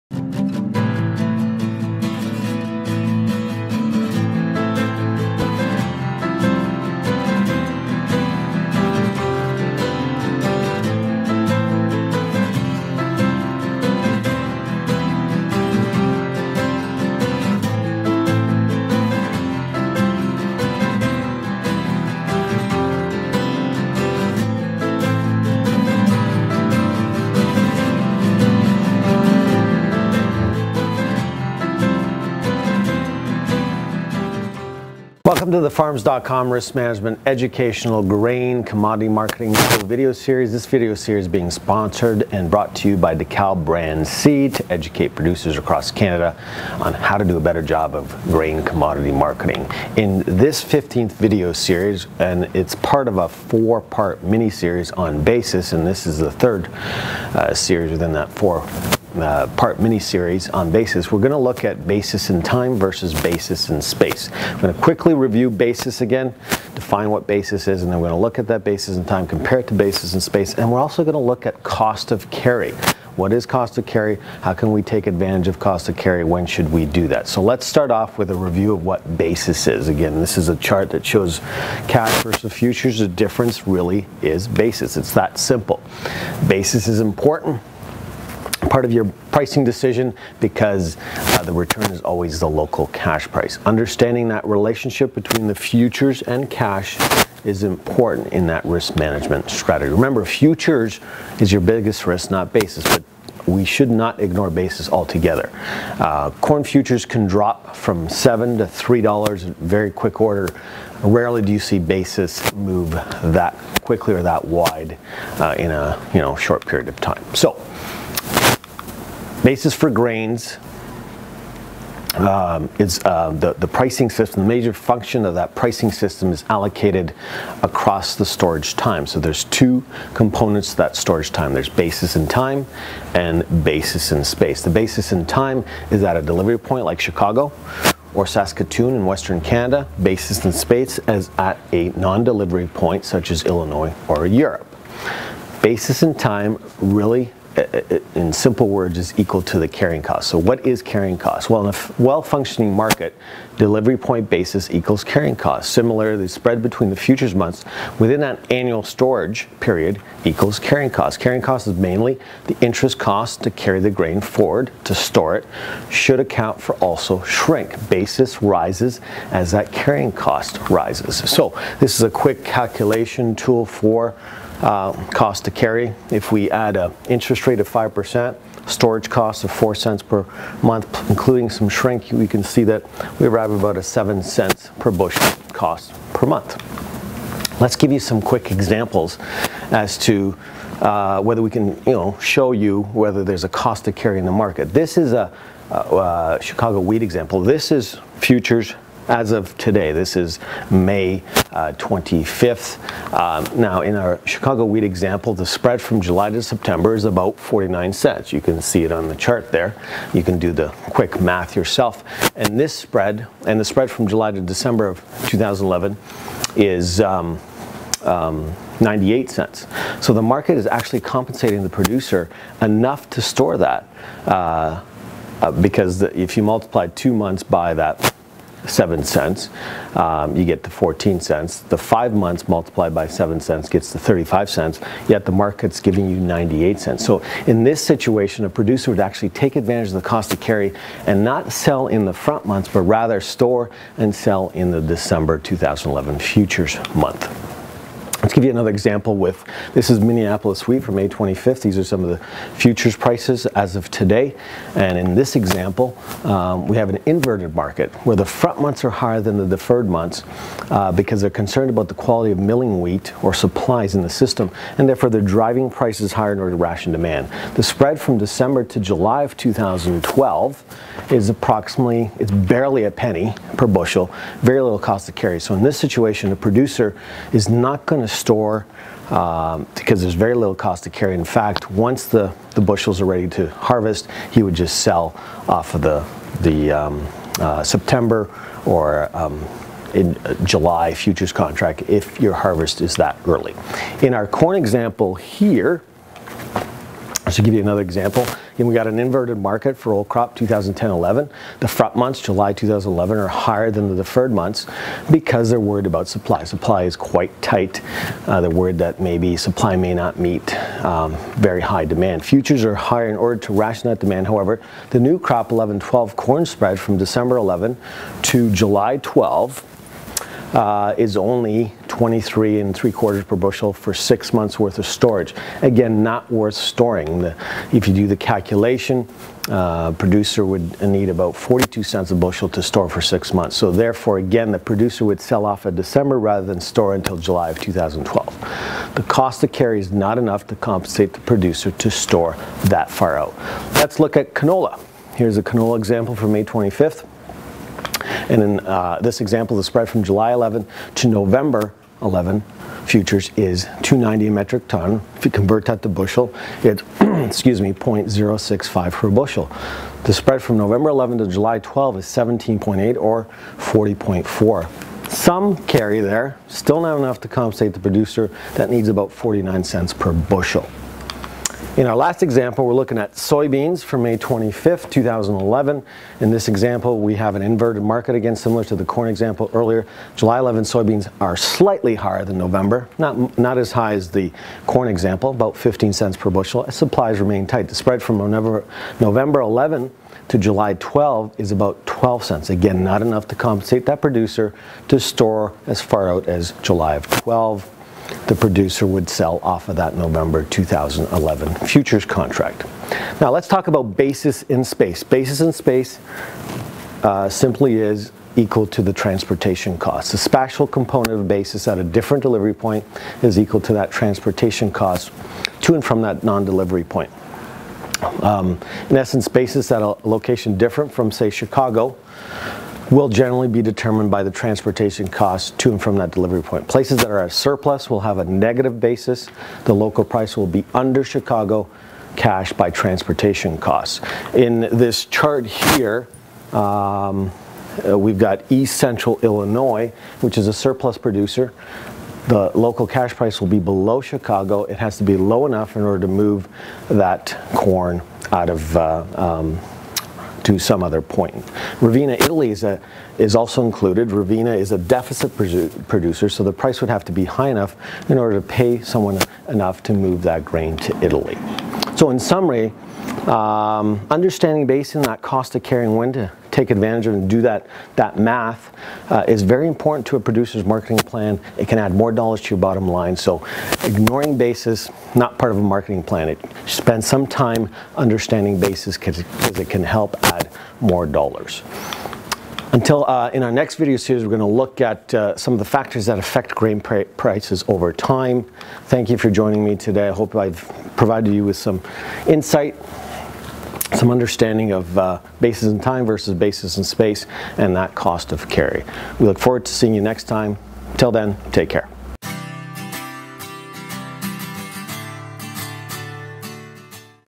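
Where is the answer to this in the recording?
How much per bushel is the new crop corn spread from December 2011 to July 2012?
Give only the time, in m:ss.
5:22.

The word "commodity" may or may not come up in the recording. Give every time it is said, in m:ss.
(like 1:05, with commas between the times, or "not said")
0:38, 0:48.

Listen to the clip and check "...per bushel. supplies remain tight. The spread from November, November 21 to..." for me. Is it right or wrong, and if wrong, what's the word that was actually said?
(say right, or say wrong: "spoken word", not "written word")
wrong: "11", not "21".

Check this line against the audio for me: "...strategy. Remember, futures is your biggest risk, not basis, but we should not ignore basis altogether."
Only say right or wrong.
right.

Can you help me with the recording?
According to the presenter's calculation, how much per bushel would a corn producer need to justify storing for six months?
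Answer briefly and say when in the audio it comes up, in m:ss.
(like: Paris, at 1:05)
42 cents, at 5:31.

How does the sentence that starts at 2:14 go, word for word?
The basis in time is at a delivery point like Chicago or Saskatoon in Western Canada.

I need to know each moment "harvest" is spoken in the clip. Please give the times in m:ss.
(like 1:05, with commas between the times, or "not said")
4:43, 4:52.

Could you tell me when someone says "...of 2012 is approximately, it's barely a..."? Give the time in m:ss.
4:29.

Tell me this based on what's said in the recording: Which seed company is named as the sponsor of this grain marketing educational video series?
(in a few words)
DeKalb.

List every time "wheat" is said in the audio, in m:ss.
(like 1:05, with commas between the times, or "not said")
3:16, 3:24, 4:10, 4:22.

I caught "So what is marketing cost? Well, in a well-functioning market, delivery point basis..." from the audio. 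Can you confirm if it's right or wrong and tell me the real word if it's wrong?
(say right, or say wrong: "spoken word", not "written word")
wrong: "carrying", not "marketing".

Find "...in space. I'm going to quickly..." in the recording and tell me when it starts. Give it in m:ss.
1:03.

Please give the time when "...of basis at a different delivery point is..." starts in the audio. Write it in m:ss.
6:51.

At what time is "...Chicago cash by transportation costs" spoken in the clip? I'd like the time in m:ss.
7:11.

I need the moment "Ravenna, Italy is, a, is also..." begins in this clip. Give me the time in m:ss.
7:31.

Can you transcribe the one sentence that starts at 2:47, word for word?
Basis rises as that carrying cost rises.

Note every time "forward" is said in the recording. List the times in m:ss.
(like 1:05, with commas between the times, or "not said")
2:44, 8:19.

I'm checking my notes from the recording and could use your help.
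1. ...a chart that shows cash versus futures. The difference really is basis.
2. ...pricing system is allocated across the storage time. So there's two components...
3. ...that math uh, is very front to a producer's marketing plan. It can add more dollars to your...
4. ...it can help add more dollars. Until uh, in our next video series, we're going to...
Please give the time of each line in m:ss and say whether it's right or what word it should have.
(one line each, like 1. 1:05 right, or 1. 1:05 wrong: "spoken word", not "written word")
1. 1:20 right
2. 2:05 right
3. 7:47 wrong: "important", not "front"
4. 7:59 right.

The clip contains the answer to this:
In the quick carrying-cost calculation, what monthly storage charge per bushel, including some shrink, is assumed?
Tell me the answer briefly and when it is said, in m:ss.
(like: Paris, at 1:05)
4 cents per month, at 2:59.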